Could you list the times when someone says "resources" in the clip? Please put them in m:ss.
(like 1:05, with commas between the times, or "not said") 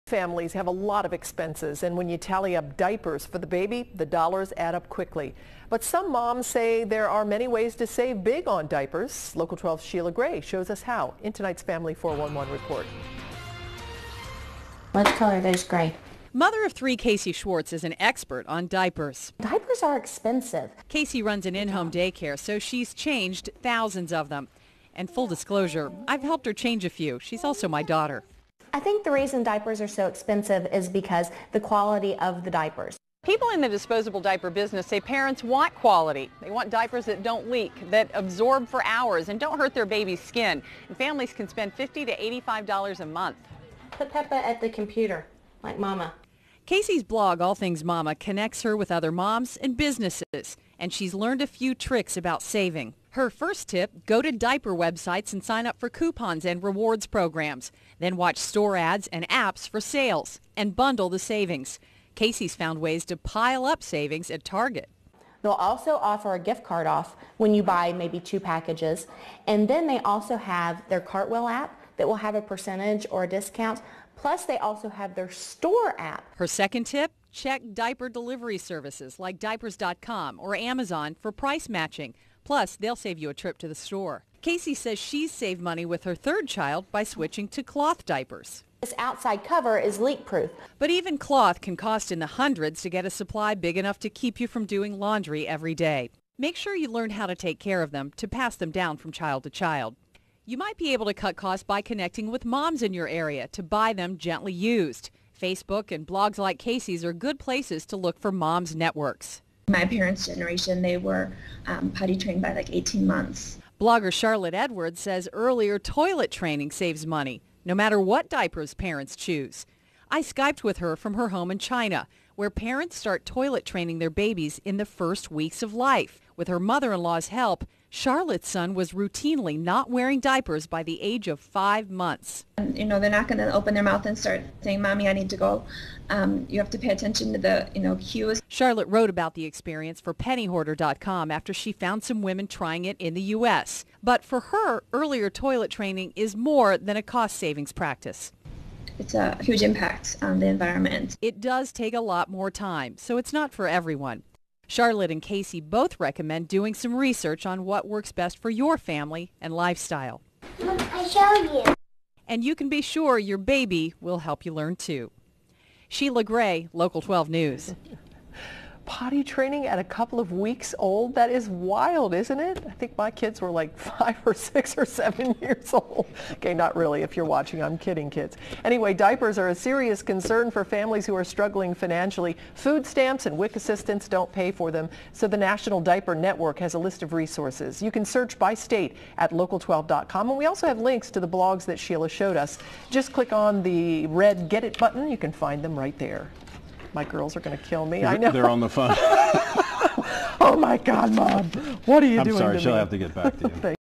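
3:07.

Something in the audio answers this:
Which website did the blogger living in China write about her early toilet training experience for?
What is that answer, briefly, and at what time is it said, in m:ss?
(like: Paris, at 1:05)
pennyhoarder.com, at 2:20.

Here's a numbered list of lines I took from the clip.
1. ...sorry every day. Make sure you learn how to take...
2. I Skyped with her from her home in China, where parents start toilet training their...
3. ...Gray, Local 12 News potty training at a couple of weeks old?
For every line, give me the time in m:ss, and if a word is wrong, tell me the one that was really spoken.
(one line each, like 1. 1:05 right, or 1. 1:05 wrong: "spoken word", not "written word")
1. 1:34 wrong: "laundry", not "sorry"
2. 2:00 right
3. 2:46 right.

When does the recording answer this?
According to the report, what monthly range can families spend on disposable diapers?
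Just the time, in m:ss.
0:41.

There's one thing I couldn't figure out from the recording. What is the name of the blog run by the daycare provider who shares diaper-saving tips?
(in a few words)
All Things Mamma.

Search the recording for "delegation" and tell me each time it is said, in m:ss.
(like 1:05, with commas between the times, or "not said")
not said.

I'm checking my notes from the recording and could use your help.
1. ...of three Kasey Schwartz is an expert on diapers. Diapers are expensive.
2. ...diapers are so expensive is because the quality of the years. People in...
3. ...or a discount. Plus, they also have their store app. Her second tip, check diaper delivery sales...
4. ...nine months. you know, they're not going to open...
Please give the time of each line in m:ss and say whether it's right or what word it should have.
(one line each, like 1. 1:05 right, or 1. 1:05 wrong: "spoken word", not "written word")
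1. 0:16 right
2. 0:29 wrong: "diapers", not "years"
3. 1:13 wrong: "services", not "sales"
4. 2:11 wrong: "five", not "nine".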